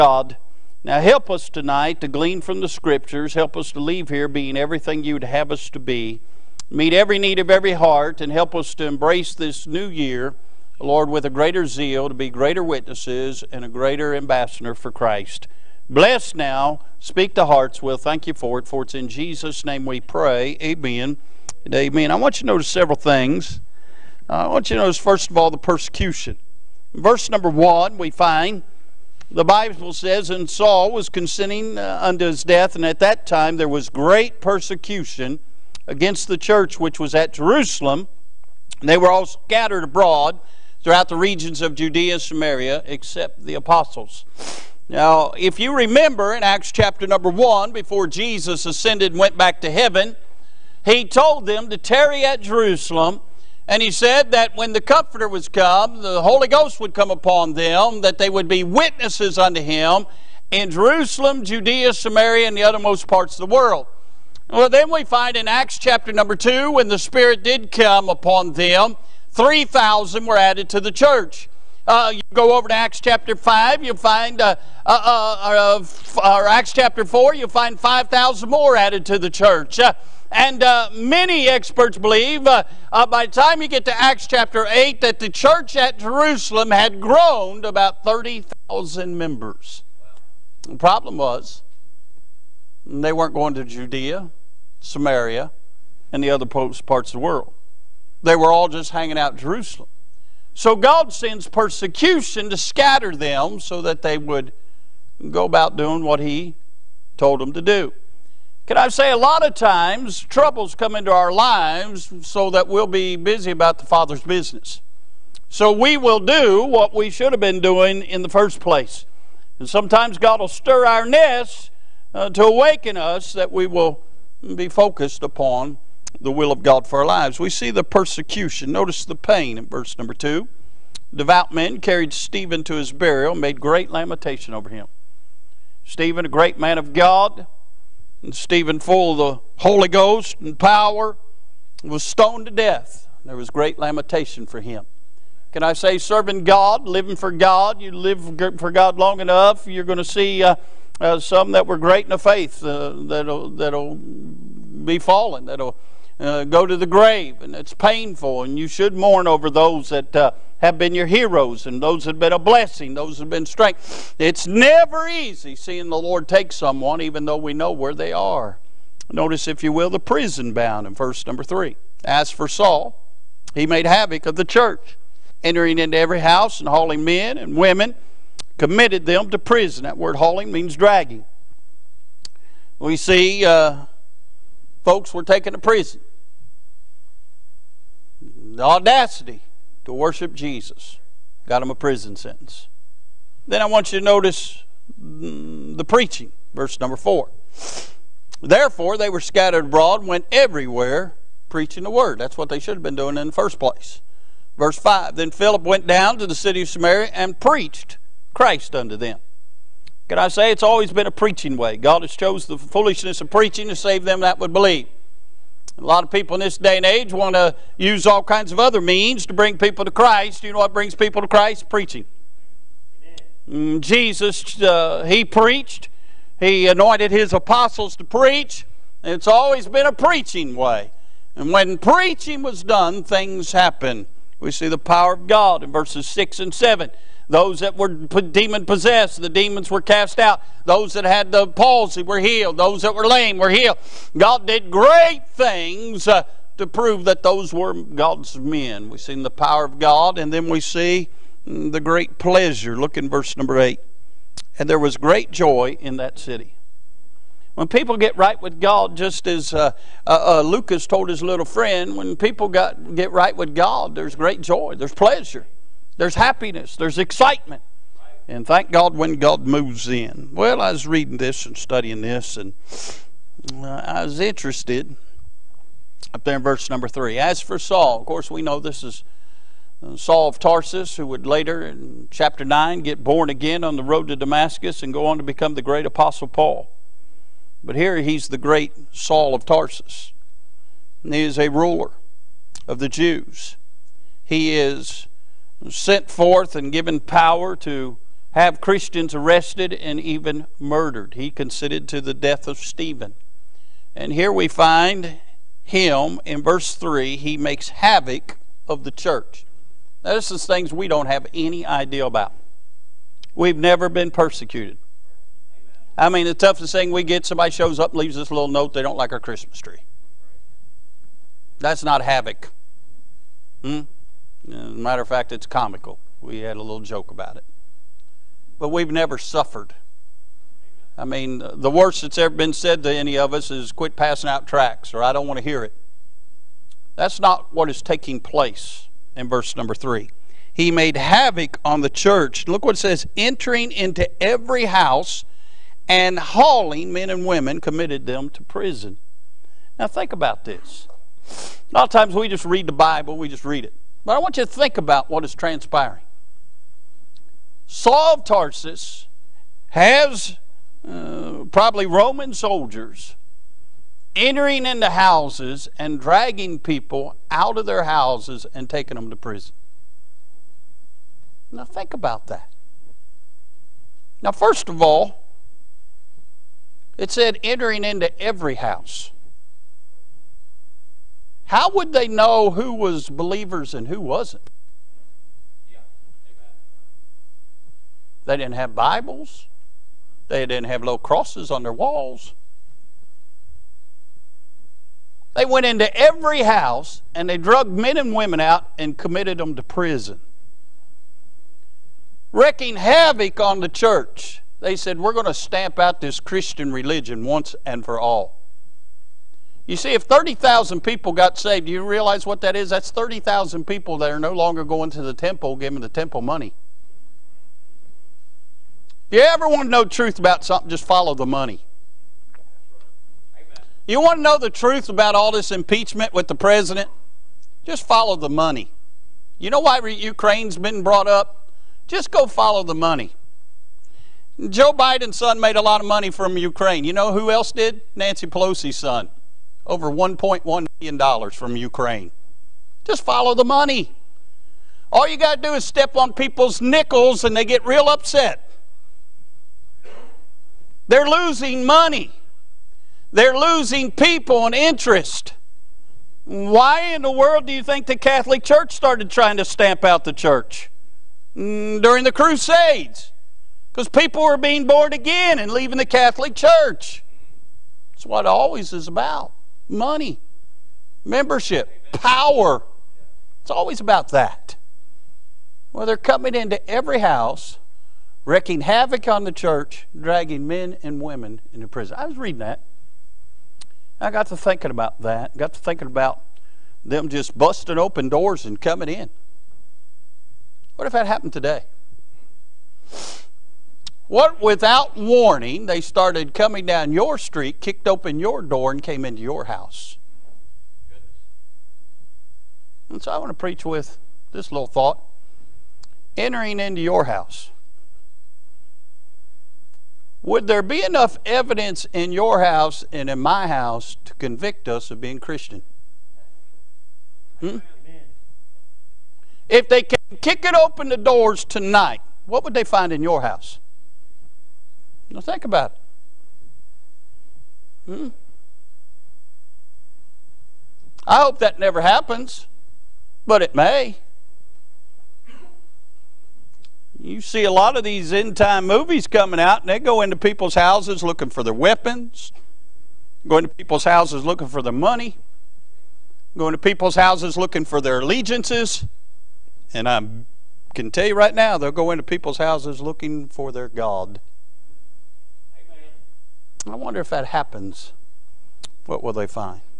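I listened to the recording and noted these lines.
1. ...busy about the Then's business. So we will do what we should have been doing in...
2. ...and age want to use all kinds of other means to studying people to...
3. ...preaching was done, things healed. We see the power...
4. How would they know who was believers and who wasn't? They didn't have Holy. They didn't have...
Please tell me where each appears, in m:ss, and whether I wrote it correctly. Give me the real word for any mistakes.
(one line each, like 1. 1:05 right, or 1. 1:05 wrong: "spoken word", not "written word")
1. 1:53 wrong: "Father", not "Then"
2. 3:36 wrong: "bring", not "studying"
3. 3:51 wrong: "happened", not "healed"
4. 6:21 wrong: "Bibles", not "Holy".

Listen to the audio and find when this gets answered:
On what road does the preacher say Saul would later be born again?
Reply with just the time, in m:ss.
4:43.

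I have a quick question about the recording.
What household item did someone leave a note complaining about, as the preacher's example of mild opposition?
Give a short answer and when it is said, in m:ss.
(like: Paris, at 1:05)
Christmas tree, at 5:19.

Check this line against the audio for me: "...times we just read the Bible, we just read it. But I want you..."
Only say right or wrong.
right.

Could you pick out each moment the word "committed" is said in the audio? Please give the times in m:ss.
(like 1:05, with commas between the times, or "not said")
2:58, 5:47, 6:38.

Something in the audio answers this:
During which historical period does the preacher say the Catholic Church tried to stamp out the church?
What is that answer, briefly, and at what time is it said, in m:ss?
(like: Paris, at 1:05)
the Crusades, at 7:42.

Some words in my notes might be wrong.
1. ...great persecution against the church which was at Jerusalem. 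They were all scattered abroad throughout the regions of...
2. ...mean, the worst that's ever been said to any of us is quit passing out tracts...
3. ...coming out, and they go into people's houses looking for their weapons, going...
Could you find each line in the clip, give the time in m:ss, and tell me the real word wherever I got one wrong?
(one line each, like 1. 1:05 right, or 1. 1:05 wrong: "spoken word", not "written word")
1. 0:33 right
2. 5:31 right
3. 8:59 right.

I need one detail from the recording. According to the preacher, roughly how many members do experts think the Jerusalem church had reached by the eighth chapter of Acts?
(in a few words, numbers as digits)
30,000.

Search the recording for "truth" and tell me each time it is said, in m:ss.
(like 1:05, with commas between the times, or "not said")
6:59, 7:04.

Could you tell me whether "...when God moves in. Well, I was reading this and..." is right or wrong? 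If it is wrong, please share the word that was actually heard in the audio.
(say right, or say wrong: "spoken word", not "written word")
right.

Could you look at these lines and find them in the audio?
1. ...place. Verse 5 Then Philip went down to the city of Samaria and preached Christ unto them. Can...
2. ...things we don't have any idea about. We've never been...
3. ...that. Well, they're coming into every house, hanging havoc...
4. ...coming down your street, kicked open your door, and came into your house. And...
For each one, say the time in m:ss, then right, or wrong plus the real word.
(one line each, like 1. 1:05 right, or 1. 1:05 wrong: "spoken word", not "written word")
1. 3:23 right
2. 5:10 right
3. 7:54 wrong: "wreaking", not "hanging"
4. 8:16 right.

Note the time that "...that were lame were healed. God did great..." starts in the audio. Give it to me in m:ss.
4:02.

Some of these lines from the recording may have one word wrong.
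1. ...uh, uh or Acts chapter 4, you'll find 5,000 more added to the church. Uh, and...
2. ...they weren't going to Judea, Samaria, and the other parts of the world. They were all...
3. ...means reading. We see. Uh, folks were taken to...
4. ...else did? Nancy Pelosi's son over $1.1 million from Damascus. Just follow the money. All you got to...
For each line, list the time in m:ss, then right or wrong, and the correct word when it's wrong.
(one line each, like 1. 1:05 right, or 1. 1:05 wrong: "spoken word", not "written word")
1. 1:15 right
2. 1:32 right
3. 3:00 wrong: "dragging", not "reading"
4. 7:17 wrong: "Ukraine", not "Damascus".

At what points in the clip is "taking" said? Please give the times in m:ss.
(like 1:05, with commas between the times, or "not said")
5:37, 6:08.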